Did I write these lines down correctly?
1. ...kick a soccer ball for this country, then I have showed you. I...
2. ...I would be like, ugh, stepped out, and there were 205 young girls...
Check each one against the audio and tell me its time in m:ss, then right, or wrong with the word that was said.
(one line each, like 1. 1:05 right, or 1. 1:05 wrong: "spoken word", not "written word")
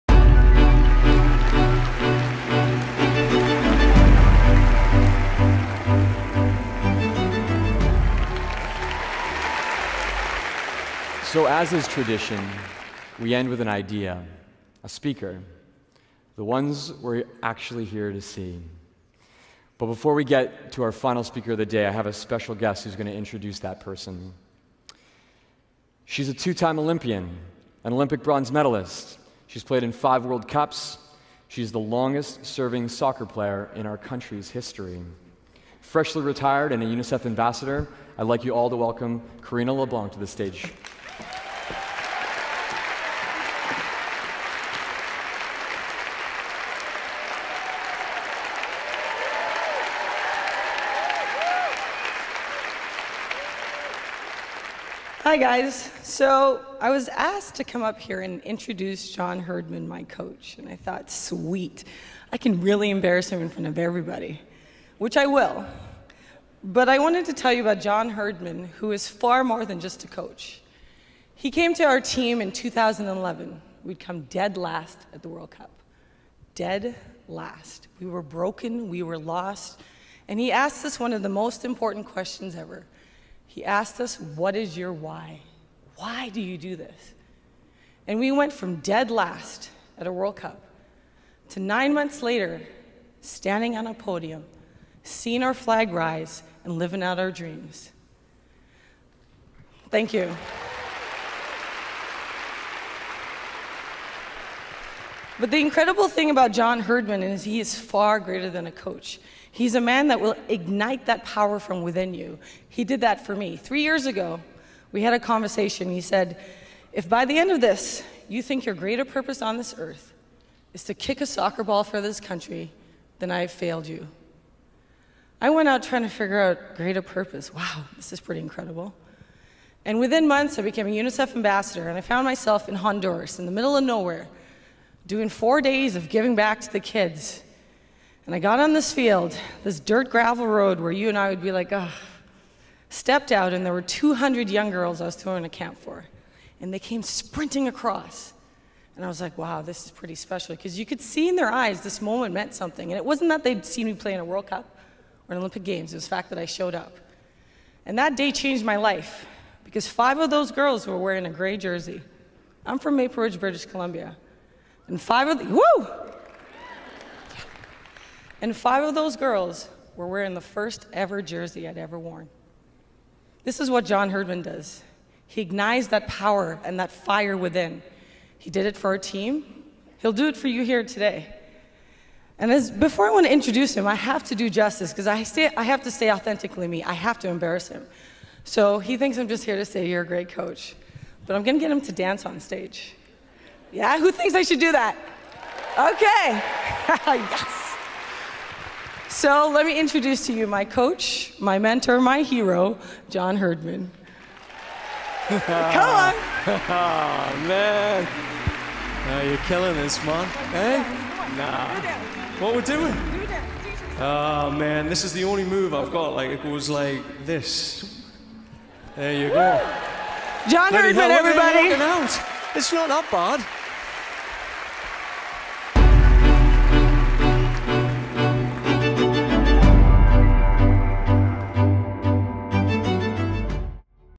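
1. 2:00 wrong: "failed", not "showed"
2. 2:21 wrong: "200", not "205".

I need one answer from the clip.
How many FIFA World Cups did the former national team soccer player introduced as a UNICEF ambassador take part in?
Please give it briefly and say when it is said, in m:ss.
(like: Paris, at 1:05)
5, at 0:29.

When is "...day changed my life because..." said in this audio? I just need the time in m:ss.
2:38.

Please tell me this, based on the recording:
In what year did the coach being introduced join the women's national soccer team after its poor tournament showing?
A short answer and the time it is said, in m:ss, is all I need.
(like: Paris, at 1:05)
2011, at 1:12.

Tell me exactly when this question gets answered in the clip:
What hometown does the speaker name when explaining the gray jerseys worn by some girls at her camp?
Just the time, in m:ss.
2:42.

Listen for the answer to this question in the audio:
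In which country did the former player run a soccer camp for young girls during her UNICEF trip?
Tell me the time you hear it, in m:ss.
2:12.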